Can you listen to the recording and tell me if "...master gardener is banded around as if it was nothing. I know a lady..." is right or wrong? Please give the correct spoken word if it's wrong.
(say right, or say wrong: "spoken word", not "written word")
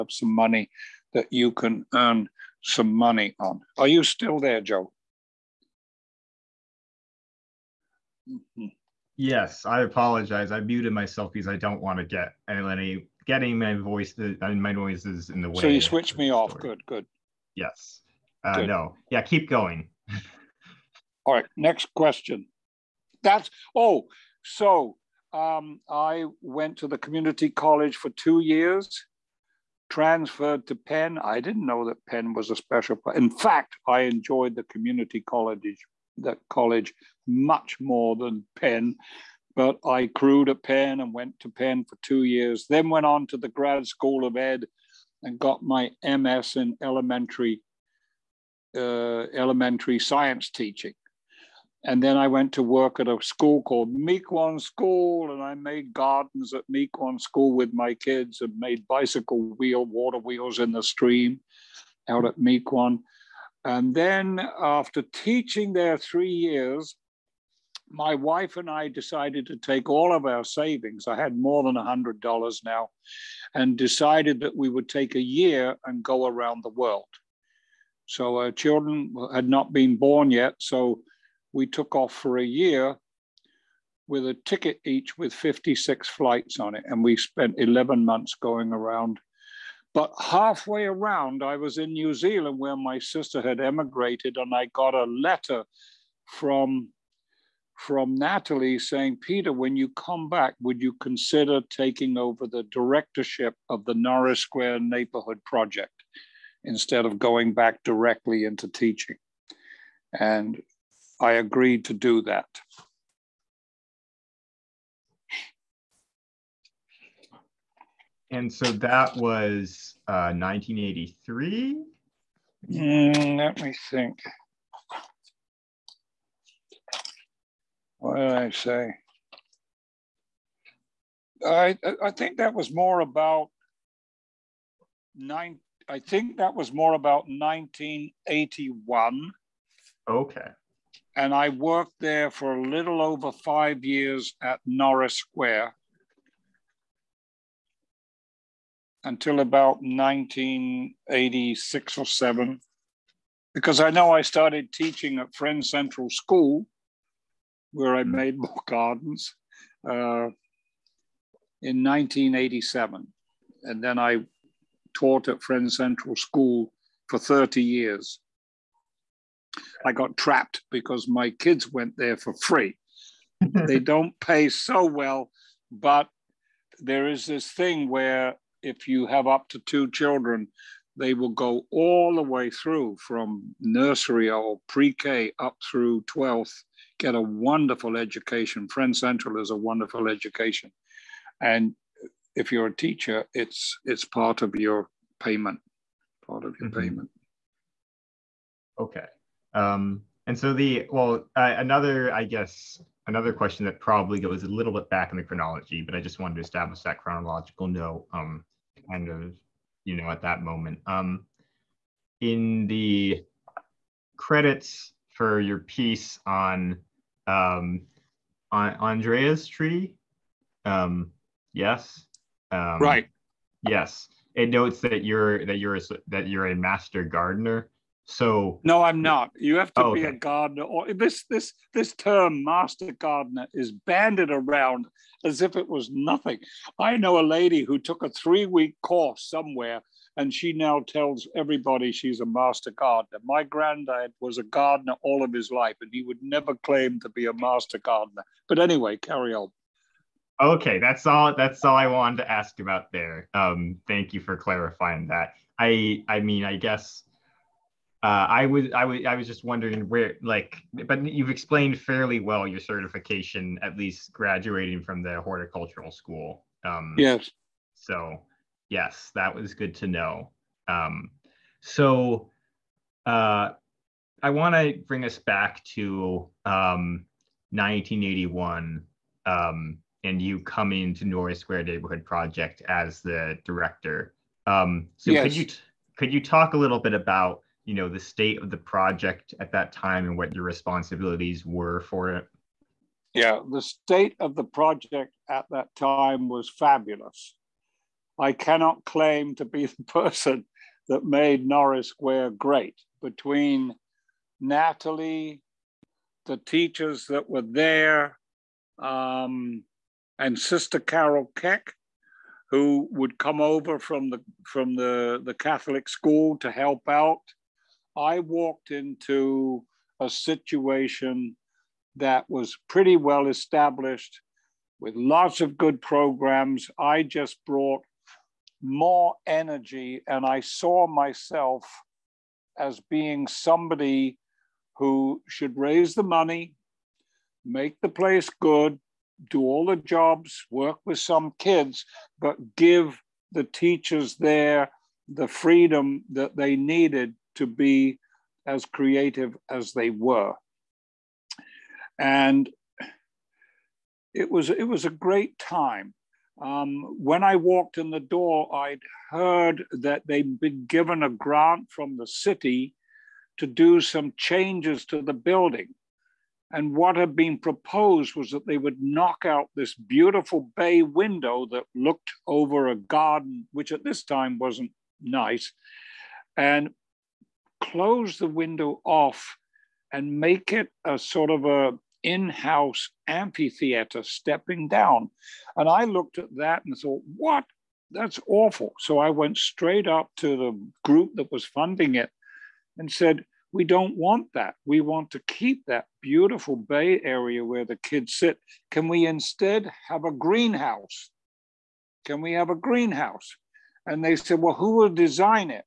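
right.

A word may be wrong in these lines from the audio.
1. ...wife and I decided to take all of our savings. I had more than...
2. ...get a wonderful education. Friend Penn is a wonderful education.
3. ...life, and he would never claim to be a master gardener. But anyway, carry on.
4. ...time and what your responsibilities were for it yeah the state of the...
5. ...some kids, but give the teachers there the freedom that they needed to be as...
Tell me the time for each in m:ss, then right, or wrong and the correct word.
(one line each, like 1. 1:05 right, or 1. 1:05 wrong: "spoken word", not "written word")
1. 1:08 right
2. 3:06 wrong: "Central", not "Penn"
3. 4:05 right
4. 4:49 right
5. 5:40 right.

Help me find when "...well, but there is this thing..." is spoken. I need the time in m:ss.
2:54.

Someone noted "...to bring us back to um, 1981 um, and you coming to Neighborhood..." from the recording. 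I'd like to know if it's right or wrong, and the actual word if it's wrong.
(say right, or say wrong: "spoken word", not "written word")
wrong: "Norris", not "Neighborhood".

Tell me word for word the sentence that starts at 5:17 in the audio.
I walked into a situation that was pretty well established with lots of good programs.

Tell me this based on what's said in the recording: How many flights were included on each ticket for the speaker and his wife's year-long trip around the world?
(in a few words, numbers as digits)
56.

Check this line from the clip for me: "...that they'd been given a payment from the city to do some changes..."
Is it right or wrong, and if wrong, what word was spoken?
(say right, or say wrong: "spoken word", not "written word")
wrong: "grant", not "payment".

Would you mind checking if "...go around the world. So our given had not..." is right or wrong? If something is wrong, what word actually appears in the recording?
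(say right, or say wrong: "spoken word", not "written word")
wrong: "children", not "given".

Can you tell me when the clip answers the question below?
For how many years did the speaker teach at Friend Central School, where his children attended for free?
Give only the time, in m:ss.
2:47.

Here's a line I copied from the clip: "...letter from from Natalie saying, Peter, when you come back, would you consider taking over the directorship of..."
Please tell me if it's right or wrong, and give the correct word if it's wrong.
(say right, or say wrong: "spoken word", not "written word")
right.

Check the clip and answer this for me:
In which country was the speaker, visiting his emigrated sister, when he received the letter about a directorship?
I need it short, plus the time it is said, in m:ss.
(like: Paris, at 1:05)
New Zealand, at 1:31.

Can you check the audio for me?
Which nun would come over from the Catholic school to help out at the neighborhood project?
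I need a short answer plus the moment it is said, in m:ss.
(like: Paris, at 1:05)
Sister Carol Keck, at 5:10.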